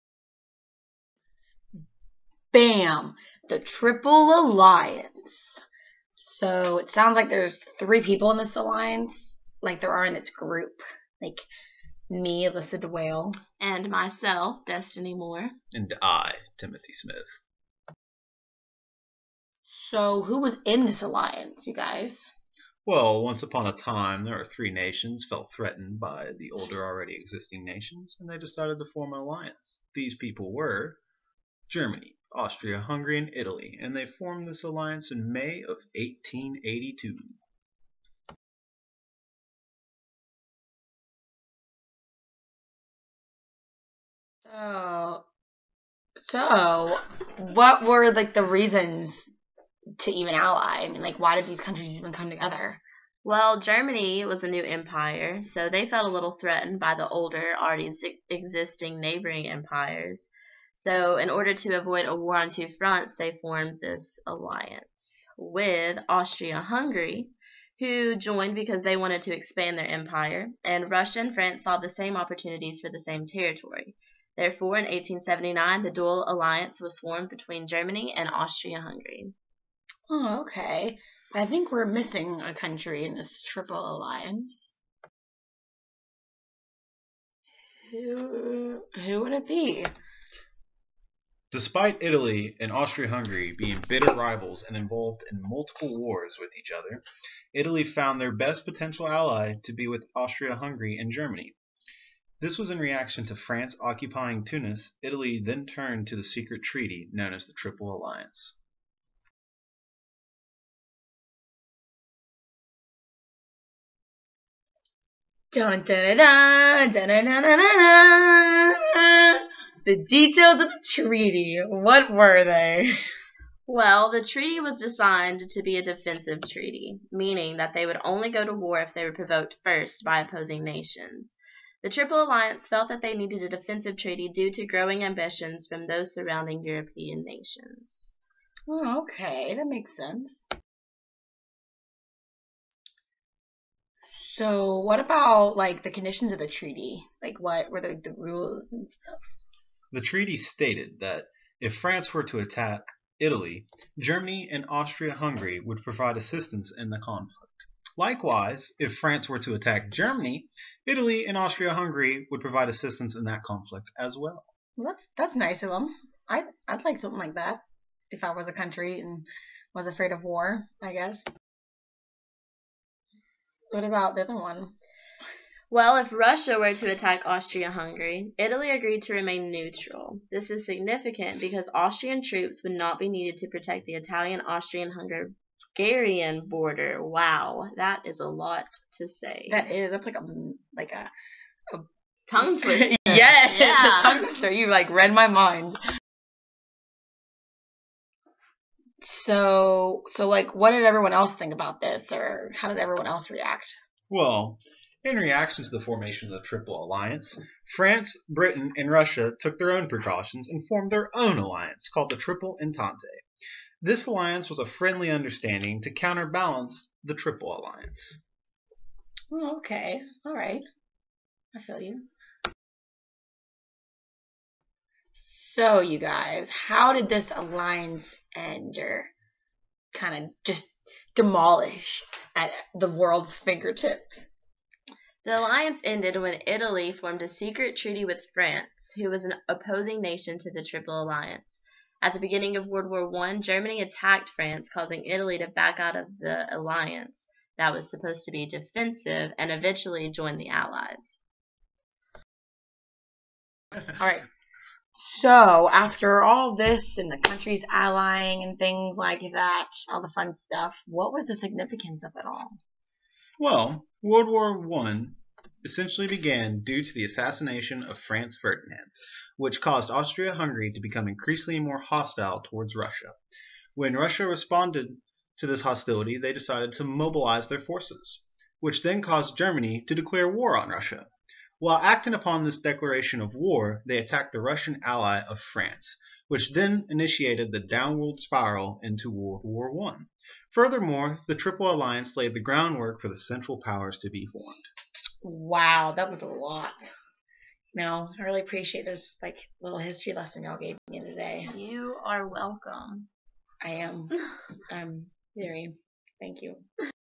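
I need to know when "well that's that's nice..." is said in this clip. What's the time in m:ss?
2:44.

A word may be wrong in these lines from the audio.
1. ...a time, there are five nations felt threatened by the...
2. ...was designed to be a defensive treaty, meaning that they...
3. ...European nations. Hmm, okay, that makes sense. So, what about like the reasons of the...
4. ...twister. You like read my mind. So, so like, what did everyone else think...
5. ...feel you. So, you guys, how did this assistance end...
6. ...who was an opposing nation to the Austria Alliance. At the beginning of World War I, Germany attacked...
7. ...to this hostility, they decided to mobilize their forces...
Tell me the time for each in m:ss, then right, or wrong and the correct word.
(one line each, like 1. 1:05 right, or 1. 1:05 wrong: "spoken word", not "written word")
1. 0:23 wrong: "three", not "five"
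2. 2:04 right
3. 2:16 wrong: "conditions", not "reasons"
4. 3:14 right
5. 3:41 wrong: "alliance", not "assistance"
6. 3:58 wrong: "Triple", not "Austria"
7. 4:35 right.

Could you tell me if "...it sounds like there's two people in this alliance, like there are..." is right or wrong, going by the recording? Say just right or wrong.
wrong.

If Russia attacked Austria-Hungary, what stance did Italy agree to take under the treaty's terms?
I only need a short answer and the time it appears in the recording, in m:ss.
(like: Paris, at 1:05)
Remain neutral, at 2:59.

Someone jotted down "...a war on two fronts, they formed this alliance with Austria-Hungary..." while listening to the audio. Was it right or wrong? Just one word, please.
right.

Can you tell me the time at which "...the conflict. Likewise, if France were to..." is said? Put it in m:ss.
2:36.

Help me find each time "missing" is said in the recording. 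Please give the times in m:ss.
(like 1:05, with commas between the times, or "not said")
1:21.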